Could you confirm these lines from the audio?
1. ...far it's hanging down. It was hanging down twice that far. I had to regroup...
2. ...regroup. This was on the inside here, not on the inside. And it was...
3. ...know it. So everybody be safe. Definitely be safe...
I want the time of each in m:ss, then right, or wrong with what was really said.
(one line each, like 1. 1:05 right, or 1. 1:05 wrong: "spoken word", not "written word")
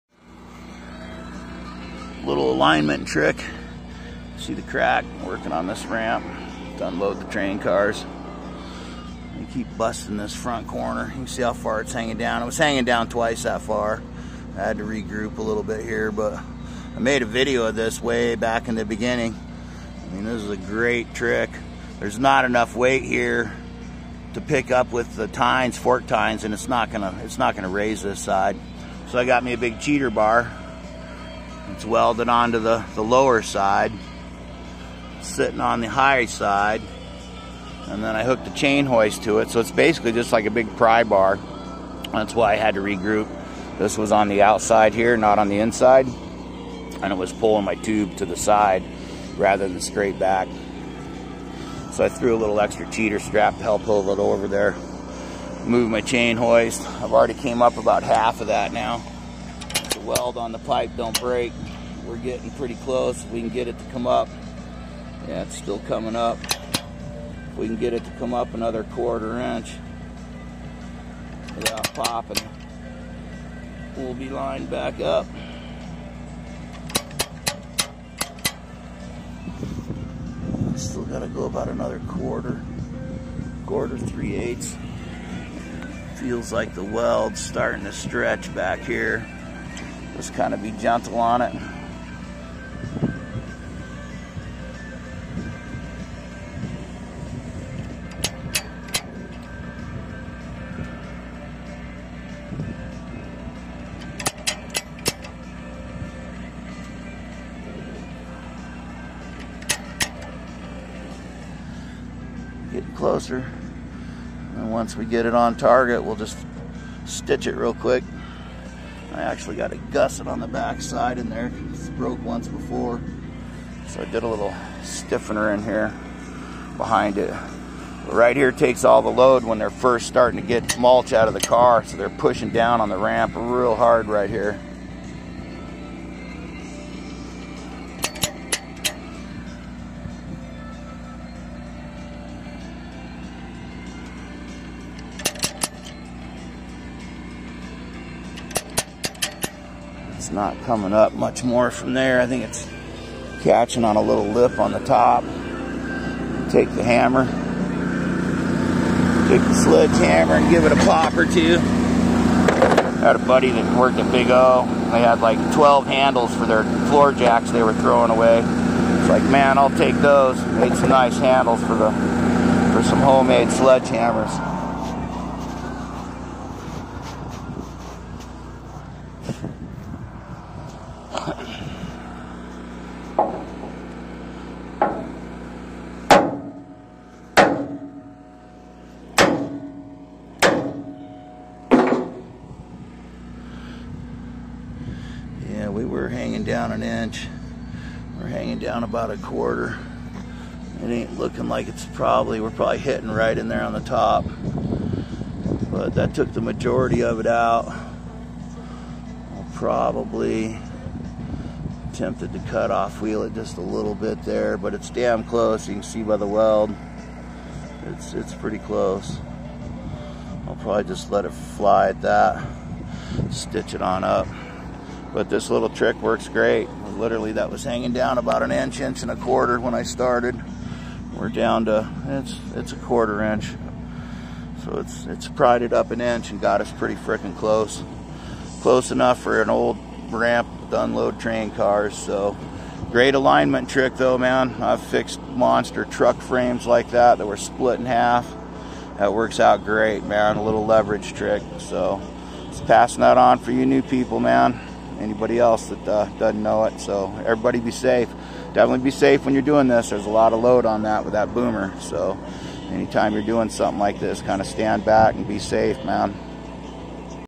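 1. 0:11 right
2. 0:42 wrong: "outside", not "inside"
3. 4:16 right.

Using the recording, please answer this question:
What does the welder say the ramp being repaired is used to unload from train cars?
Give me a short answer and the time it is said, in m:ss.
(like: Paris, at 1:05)
mulch, at 2:10.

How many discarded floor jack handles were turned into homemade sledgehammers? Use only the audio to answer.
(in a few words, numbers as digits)
12.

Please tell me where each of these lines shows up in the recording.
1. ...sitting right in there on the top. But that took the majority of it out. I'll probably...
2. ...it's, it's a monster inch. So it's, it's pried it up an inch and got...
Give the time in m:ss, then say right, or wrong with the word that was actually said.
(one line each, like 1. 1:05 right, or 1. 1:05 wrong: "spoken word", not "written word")
1. 3:22 wrong: "hitting", not "sitting"
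2. 3:52 wrong: "quarter", not "monster".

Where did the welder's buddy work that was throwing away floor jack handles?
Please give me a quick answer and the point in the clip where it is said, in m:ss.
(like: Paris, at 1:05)
Big O, at 2:44.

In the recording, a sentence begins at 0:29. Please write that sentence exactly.
So I got me a big cheater bar it's welded onto the, the lower side, sitting on the high side.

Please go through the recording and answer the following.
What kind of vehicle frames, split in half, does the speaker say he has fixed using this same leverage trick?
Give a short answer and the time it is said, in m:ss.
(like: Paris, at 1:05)
monster truck frames, at 4:05.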